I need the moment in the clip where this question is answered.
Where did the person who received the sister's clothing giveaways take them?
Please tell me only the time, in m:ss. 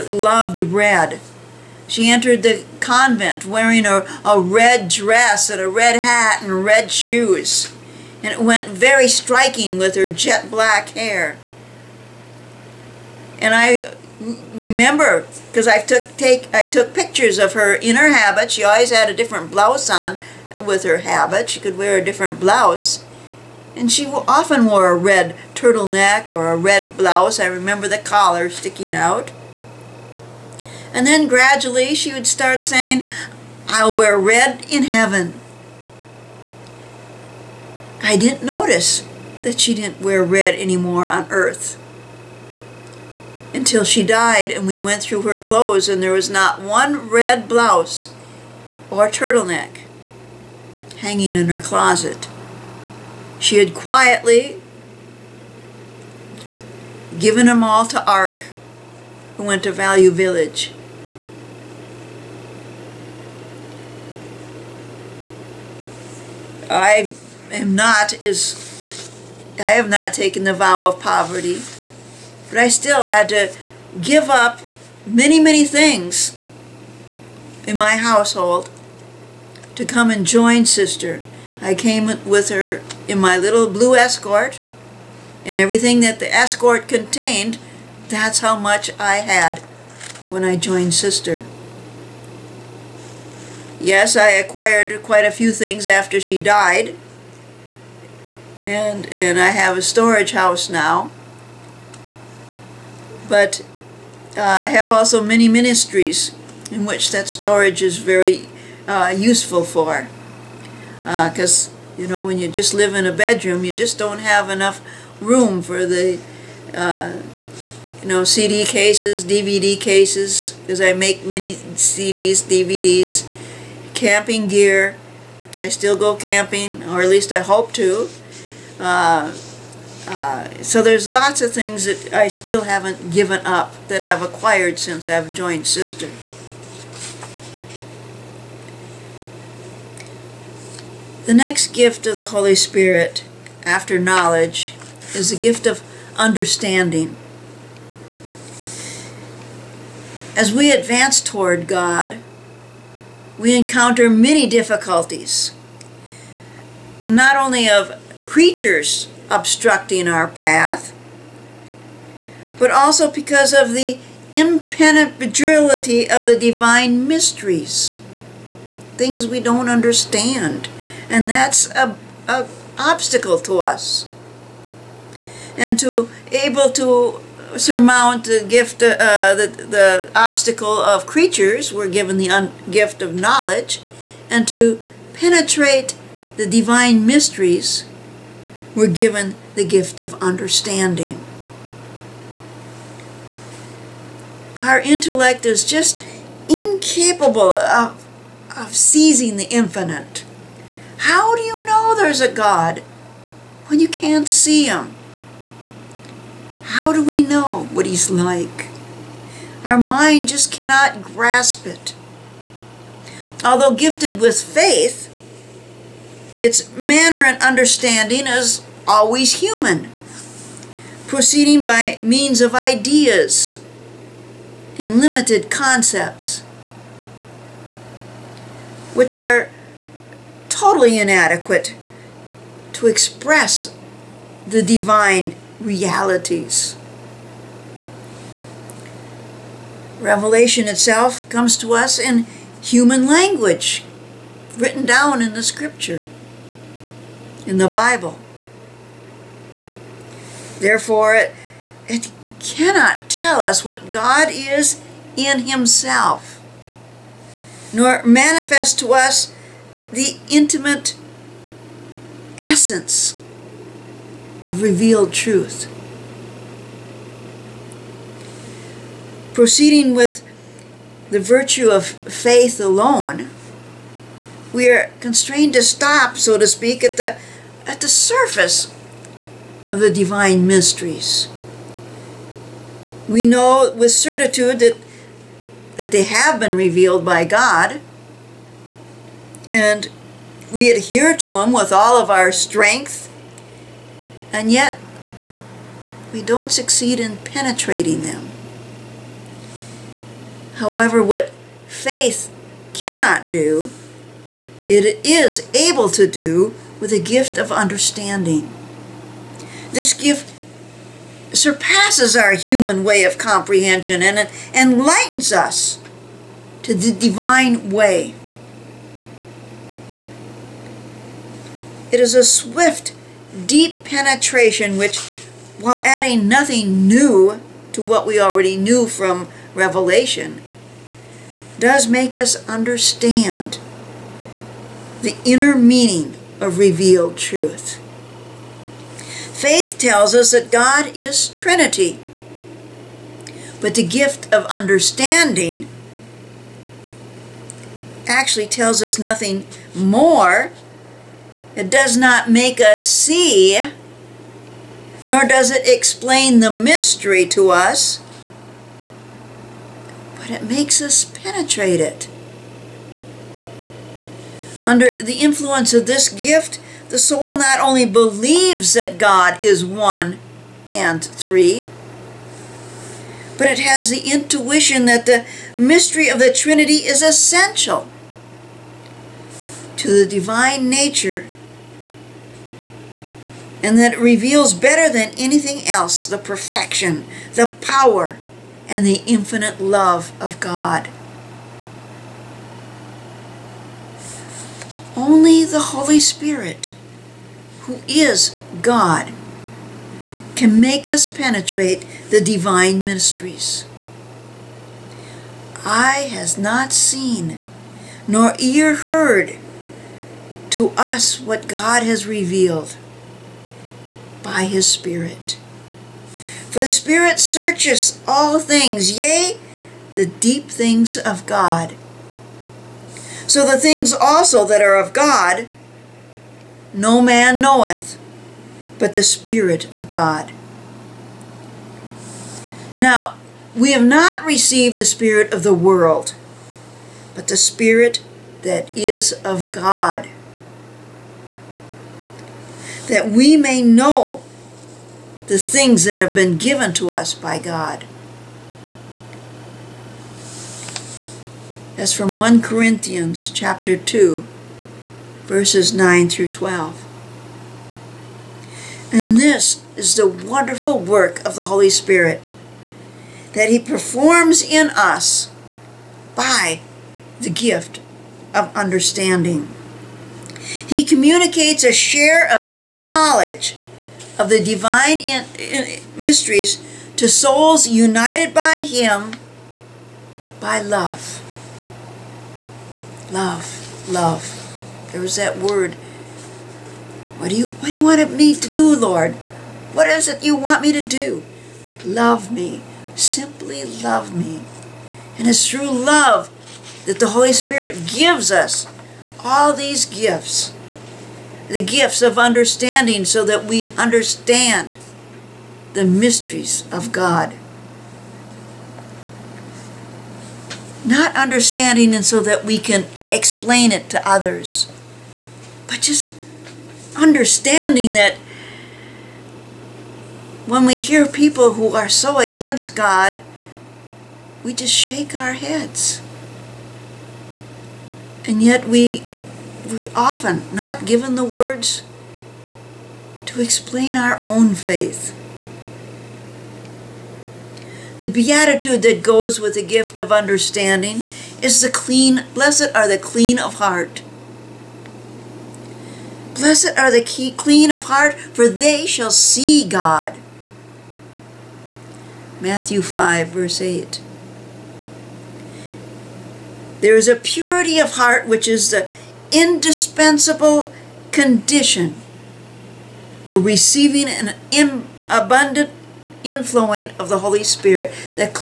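0:59.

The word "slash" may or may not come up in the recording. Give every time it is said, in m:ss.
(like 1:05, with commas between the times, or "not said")
not said.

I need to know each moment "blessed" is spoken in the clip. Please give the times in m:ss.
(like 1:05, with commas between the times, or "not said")
9:02, 9:06.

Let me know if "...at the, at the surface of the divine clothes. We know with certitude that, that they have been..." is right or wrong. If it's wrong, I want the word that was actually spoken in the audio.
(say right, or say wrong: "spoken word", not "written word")
wrong: "mysteries", not "clothes".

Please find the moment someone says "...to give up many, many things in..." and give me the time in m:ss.
1:13.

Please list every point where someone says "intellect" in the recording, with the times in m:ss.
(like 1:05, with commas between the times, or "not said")
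3:14.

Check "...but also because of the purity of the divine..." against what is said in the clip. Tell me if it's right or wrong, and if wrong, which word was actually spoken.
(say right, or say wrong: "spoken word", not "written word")
wrong: "impenetrability", not "purity".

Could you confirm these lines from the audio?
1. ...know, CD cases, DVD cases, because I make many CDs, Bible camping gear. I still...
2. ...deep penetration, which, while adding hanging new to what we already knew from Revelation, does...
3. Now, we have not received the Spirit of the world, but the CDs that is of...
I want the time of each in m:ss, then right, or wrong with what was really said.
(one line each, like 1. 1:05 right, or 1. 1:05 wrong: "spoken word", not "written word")
1. 1:58 wrong: "DVDs", not "Bible"
2. 5:23 wrong: "nothing", not "hanging"
3. 7:12 wrong: "Spirit", not "CDs".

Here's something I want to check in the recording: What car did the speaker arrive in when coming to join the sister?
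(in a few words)
Blue Escort.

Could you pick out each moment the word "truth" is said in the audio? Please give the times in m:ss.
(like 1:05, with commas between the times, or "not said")
4:25, 5:37.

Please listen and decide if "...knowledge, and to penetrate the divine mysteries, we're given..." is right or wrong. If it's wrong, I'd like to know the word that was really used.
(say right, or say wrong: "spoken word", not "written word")
right.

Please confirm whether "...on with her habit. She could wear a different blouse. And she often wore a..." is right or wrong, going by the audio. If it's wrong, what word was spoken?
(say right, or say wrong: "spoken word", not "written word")
right.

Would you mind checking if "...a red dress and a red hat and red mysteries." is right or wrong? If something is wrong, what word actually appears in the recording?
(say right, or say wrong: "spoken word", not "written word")
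wrong: "shoes", not "mysteries".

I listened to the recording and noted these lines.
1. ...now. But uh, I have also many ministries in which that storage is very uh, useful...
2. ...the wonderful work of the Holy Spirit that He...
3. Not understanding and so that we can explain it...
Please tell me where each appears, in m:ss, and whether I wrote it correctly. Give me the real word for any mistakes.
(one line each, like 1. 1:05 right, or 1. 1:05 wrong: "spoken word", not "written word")
1. 1:40 right
2. 7:39 right
3. 8:30 right.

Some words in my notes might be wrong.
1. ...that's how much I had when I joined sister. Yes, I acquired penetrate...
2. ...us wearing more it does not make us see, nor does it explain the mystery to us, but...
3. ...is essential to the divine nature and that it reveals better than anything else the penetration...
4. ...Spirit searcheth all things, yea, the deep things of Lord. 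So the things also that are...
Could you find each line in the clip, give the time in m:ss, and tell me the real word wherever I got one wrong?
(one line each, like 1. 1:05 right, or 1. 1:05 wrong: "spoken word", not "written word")
1. 1:28 wrong: "quite", not "penetrate"
2. 5:48 wrong: "nothing", not "wearing"
3. 6:16 wrong: "perfection", not "penetration"
4. 6:56 wrong: "God", not "Lord".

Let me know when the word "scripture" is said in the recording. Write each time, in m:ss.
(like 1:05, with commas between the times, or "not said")
4:05.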